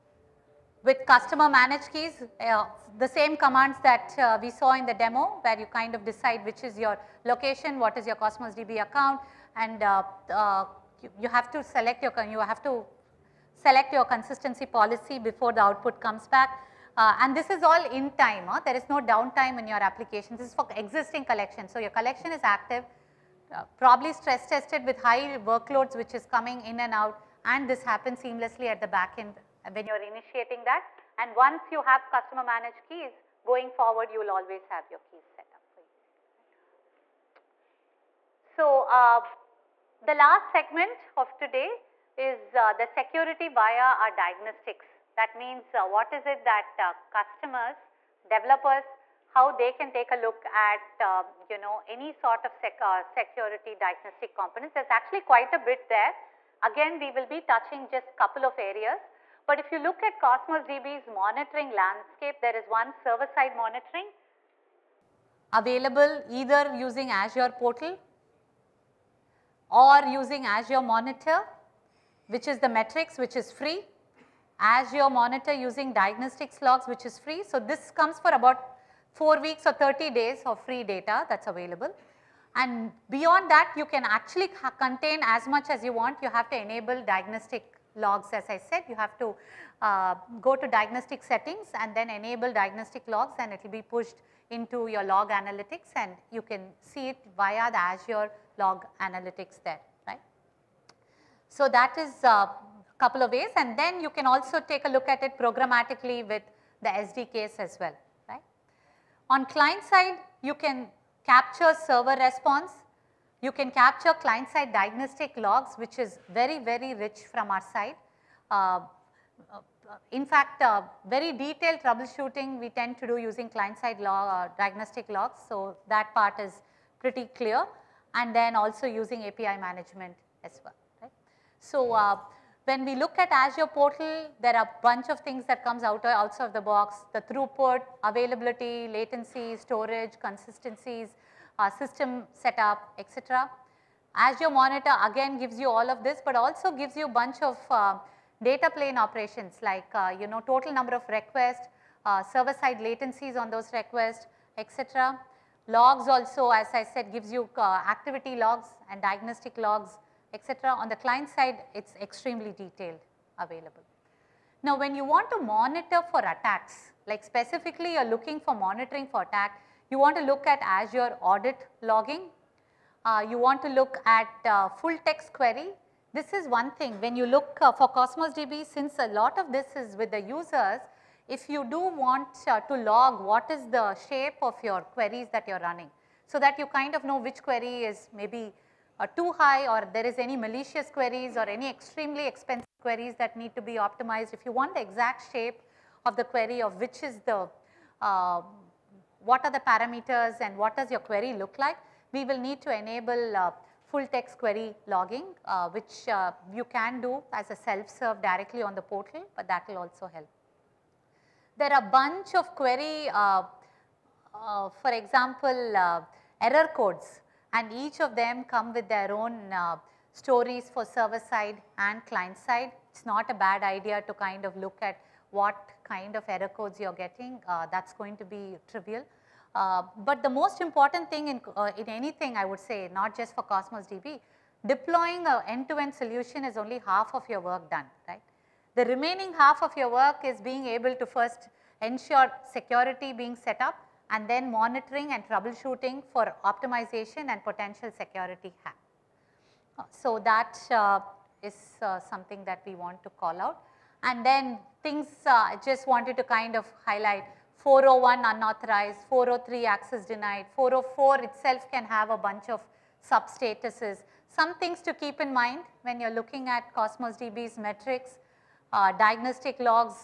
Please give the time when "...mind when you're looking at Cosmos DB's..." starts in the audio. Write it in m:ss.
4:25.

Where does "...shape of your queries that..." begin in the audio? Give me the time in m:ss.
3:04.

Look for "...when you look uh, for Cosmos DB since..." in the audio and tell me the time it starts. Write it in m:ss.
2:56.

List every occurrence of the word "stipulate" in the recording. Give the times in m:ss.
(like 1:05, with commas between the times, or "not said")
not said.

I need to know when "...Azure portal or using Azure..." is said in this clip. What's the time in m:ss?
1:07.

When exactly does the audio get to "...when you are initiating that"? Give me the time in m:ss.
0:29.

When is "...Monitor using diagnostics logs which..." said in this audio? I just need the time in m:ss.
1:15.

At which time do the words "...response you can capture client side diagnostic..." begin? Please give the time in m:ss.
1:52.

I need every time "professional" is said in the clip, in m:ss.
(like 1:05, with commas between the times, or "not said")
not said.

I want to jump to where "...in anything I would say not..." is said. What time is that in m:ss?
3:51.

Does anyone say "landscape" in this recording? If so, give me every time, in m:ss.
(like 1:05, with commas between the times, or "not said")
1:01.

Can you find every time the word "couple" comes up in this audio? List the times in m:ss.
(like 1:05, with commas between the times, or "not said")
0:58, 1:42.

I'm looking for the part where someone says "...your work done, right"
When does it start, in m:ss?
3:57.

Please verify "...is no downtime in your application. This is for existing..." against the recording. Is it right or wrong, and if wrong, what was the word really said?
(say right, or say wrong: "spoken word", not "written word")
right.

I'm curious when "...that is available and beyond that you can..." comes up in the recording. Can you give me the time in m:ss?
1:21.